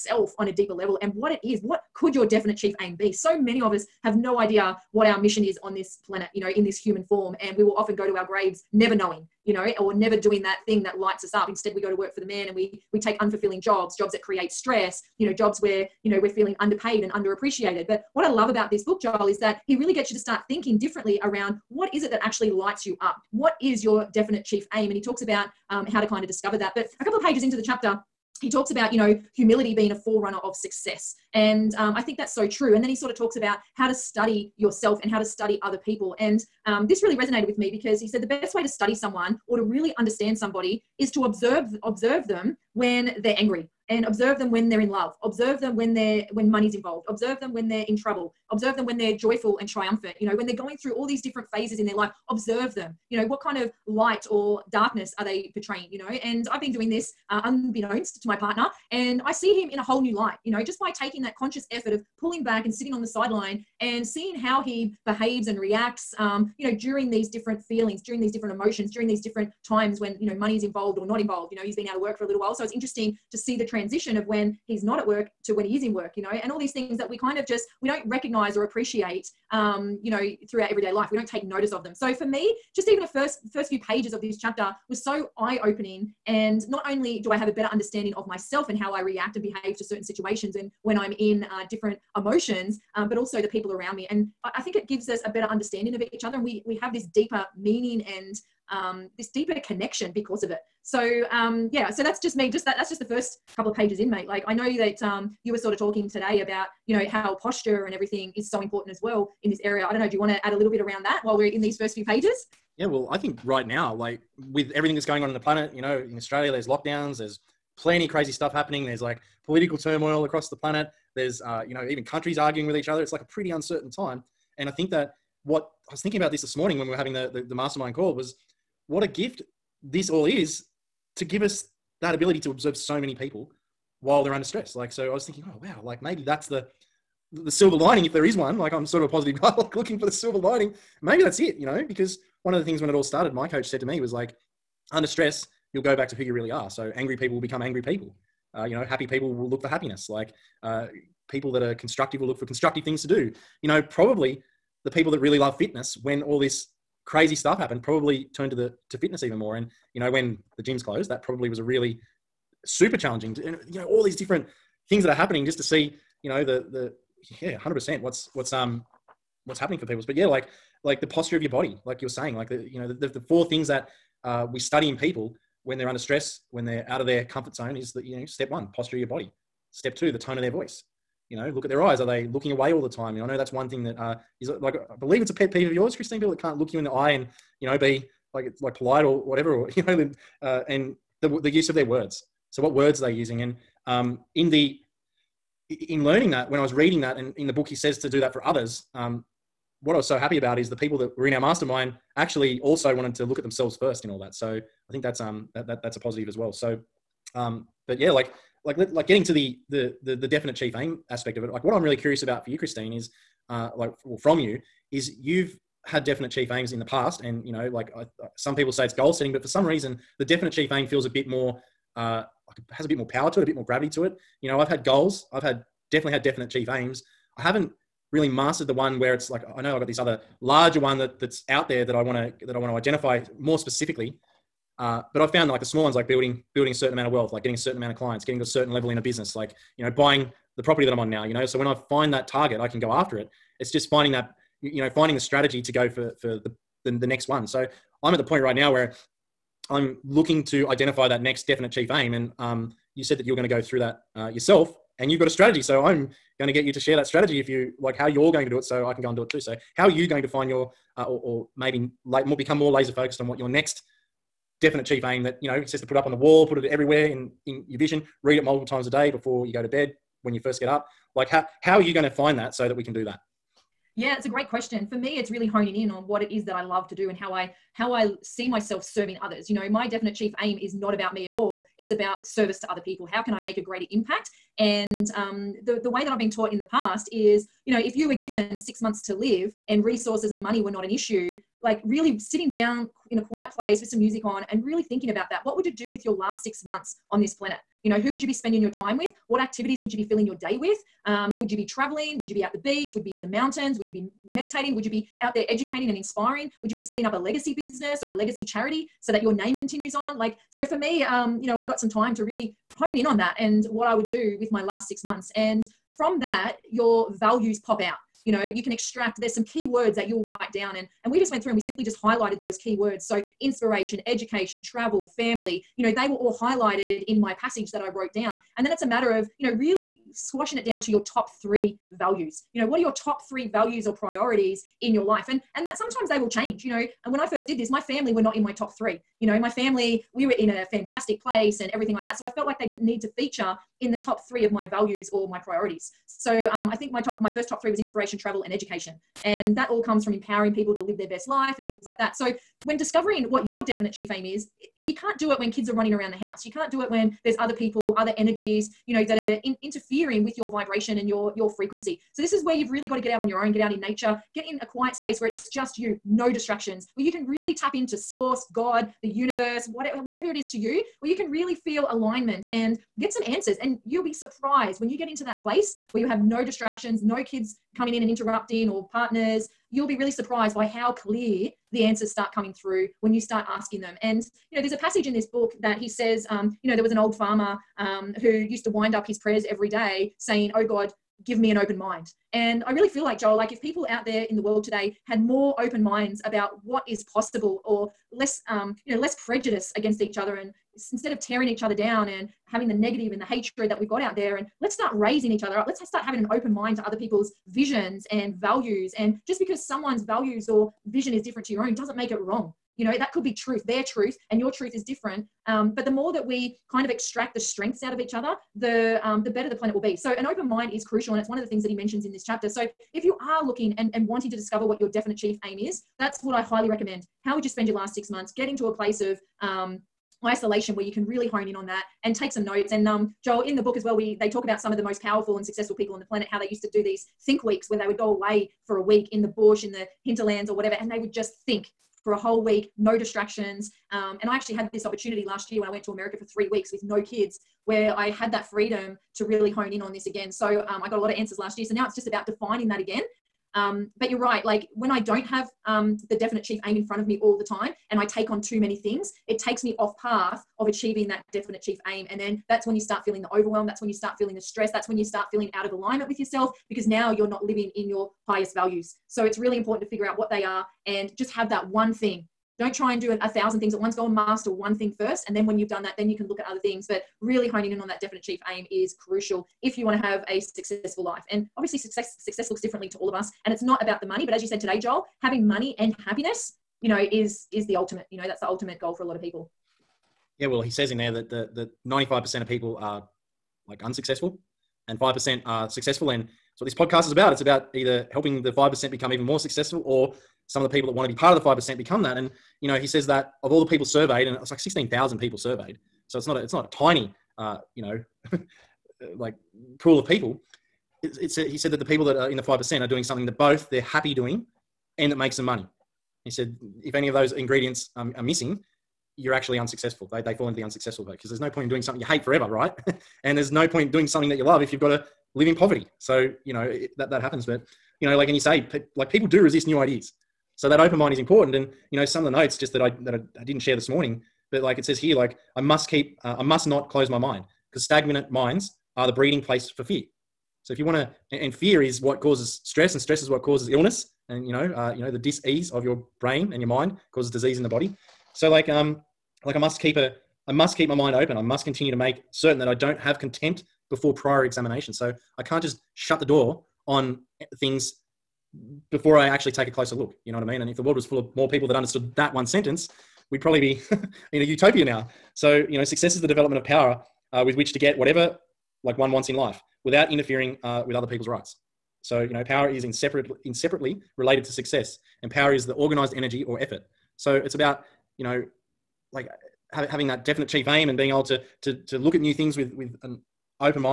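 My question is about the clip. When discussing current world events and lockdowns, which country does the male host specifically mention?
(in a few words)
Australia.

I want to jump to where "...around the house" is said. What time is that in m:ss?
5:55.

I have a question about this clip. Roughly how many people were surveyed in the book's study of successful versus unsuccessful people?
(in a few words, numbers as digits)
16,000.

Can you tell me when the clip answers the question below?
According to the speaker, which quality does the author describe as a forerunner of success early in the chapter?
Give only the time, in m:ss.
0:29.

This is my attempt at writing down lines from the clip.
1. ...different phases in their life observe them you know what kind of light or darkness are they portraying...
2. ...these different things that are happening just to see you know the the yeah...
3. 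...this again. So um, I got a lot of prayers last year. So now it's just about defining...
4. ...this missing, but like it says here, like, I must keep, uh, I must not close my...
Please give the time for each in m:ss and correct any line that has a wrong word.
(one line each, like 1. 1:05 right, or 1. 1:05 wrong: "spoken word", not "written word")
1. 0:51 right
2. 2:44 right
3. 7:29 wrong: "answers", not "prayers"
4. 8:53 wrong: "morning", not "missing".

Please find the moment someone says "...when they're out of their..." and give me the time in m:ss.
2:56.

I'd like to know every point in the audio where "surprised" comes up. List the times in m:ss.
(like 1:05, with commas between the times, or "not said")
6:14, 6:20.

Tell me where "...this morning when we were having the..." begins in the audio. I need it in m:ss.
2:06.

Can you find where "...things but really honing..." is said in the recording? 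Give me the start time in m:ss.
7:56.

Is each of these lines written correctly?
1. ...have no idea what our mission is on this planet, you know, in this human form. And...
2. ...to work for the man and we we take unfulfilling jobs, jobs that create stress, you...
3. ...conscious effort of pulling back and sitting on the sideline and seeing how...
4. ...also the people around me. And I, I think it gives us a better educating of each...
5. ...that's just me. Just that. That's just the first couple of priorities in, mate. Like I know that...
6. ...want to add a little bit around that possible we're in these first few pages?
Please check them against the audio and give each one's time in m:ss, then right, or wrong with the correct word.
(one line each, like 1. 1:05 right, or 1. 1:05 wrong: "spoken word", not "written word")
1. 0:04 right
2. 0:11 right
3. 1:01 right
4. 1:33 wrong: "understanding", not "educating"
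5. 1:42 wrong: "pages", not "priorities"
6. 1:50 wrong: "while", not "possible".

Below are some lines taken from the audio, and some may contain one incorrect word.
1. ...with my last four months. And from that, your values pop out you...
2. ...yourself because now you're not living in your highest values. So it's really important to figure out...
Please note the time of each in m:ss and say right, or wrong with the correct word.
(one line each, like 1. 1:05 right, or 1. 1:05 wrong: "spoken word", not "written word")
1. 5:14 wrong: "six", not "four"
2. 7:46 right.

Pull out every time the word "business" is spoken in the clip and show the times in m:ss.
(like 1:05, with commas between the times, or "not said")
3:59, 5:07.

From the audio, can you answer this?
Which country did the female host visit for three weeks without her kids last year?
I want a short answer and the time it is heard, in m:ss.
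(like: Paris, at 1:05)
America, at 7:25.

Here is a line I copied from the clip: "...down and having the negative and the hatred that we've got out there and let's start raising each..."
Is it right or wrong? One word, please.
right.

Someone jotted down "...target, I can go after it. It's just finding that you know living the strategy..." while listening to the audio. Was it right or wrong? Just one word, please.
wrong.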